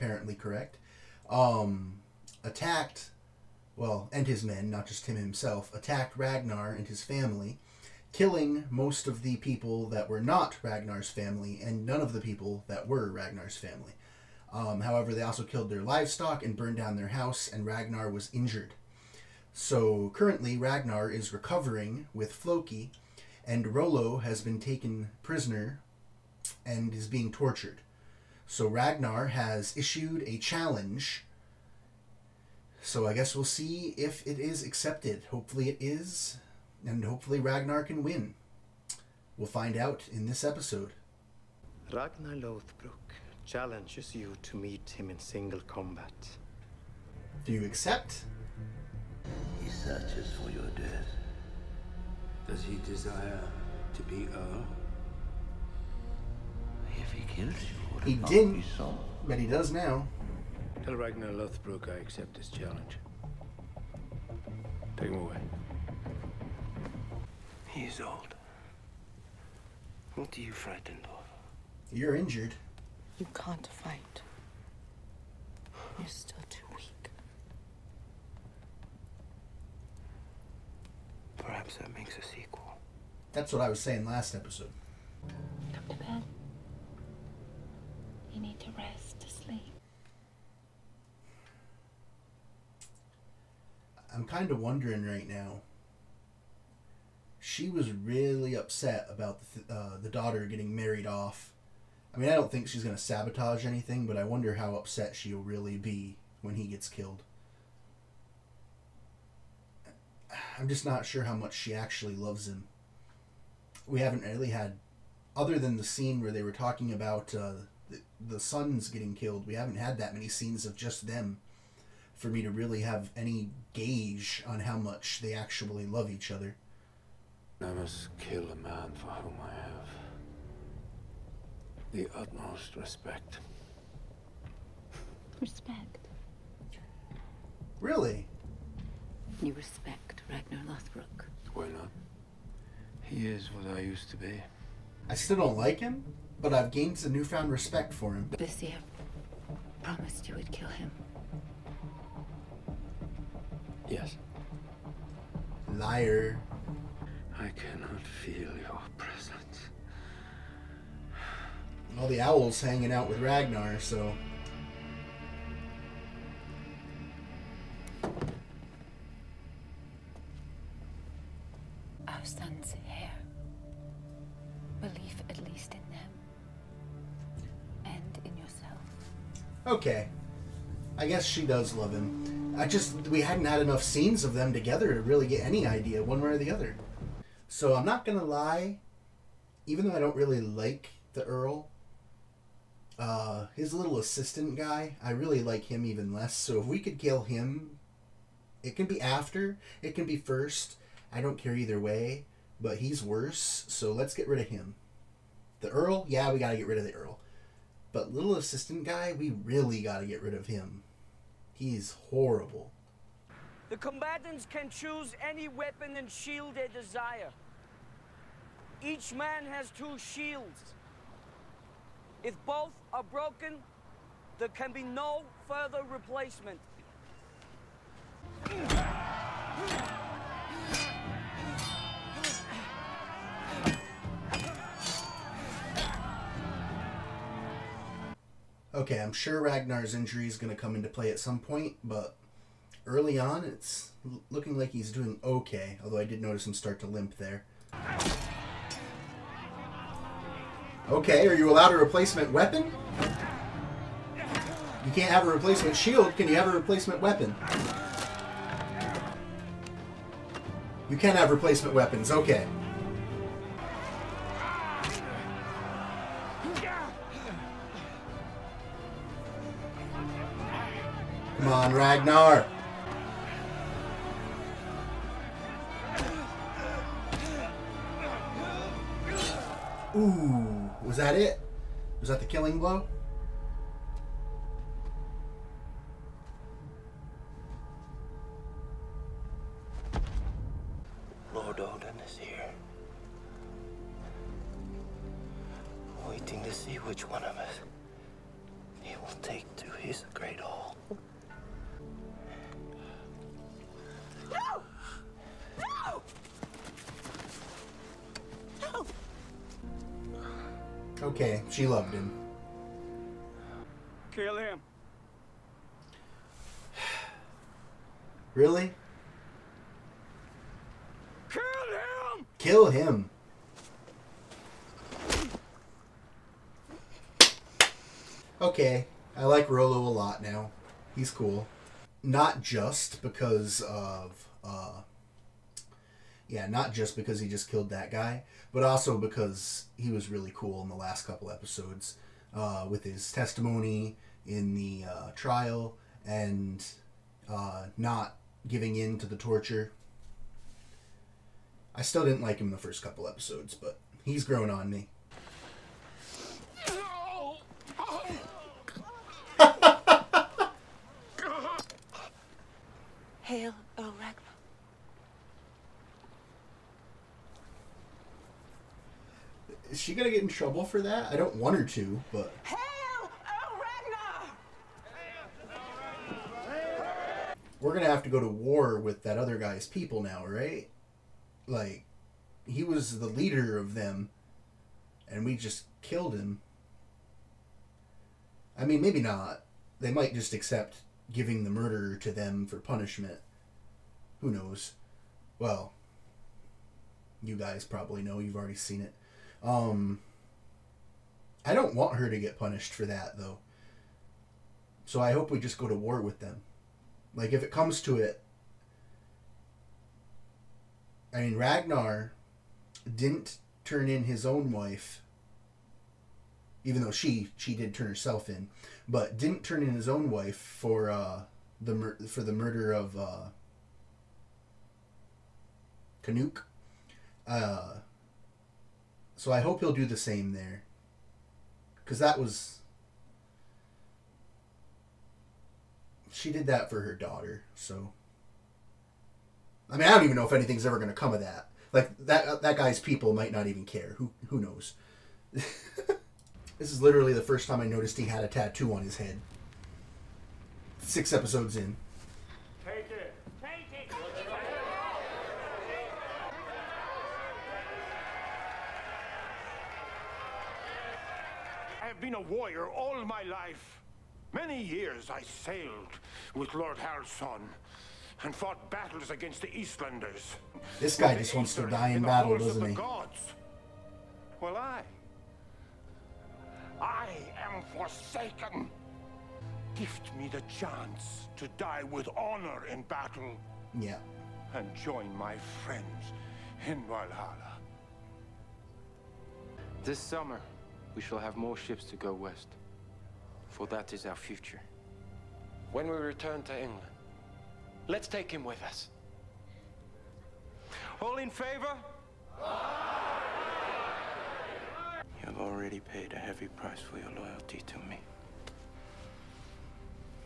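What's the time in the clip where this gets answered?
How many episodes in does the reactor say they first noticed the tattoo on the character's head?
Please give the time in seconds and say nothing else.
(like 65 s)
450 s.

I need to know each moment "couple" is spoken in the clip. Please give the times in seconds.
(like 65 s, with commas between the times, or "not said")
341 s, 352 s.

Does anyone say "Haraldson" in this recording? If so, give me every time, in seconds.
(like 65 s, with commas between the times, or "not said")
466 s.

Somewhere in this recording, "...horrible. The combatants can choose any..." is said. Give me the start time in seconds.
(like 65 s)
212 s.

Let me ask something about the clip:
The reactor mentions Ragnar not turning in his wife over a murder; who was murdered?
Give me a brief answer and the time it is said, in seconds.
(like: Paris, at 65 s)
Knut, at 426 s.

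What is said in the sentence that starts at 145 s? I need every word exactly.
I still don't like him, but I've gained some newfound respect for him.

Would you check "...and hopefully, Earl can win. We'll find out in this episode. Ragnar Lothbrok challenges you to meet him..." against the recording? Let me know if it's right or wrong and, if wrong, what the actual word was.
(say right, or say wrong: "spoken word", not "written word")
wrong: "Ragnar", not "Earl".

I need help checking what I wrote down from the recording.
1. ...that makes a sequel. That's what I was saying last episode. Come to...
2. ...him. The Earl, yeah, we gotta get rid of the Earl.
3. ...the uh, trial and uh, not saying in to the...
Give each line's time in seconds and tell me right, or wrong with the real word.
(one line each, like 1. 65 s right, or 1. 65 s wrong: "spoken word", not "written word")
1. 81 s right
2. 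204 s right
3. 344 s wrong: "giving", not "saying".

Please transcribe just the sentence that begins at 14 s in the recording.
Um, however, they also killed their livestock and burned down their house, and Ragnar was injured.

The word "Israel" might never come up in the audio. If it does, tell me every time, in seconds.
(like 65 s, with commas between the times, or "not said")
not said.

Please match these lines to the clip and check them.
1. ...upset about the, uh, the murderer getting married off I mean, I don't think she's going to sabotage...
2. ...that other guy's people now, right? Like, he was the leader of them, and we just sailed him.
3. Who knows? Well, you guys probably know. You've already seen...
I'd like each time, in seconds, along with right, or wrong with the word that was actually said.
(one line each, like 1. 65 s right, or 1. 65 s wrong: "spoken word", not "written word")
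1. 98 s wrong: "daughter", not "murderer"
2. 379 s wrong: "killed", not "sailed"
3. 394 s right.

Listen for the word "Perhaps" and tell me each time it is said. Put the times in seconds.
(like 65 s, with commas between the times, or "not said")
81 s.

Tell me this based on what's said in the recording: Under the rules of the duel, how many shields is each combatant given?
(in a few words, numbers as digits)
2.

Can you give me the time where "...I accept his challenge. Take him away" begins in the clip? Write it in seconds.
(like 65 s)
61 s.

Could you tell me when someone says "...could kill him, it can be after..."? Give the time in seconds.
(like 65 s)
196 s.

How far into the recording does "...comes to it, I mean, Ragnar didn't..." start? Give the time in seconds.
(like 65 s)
407 s.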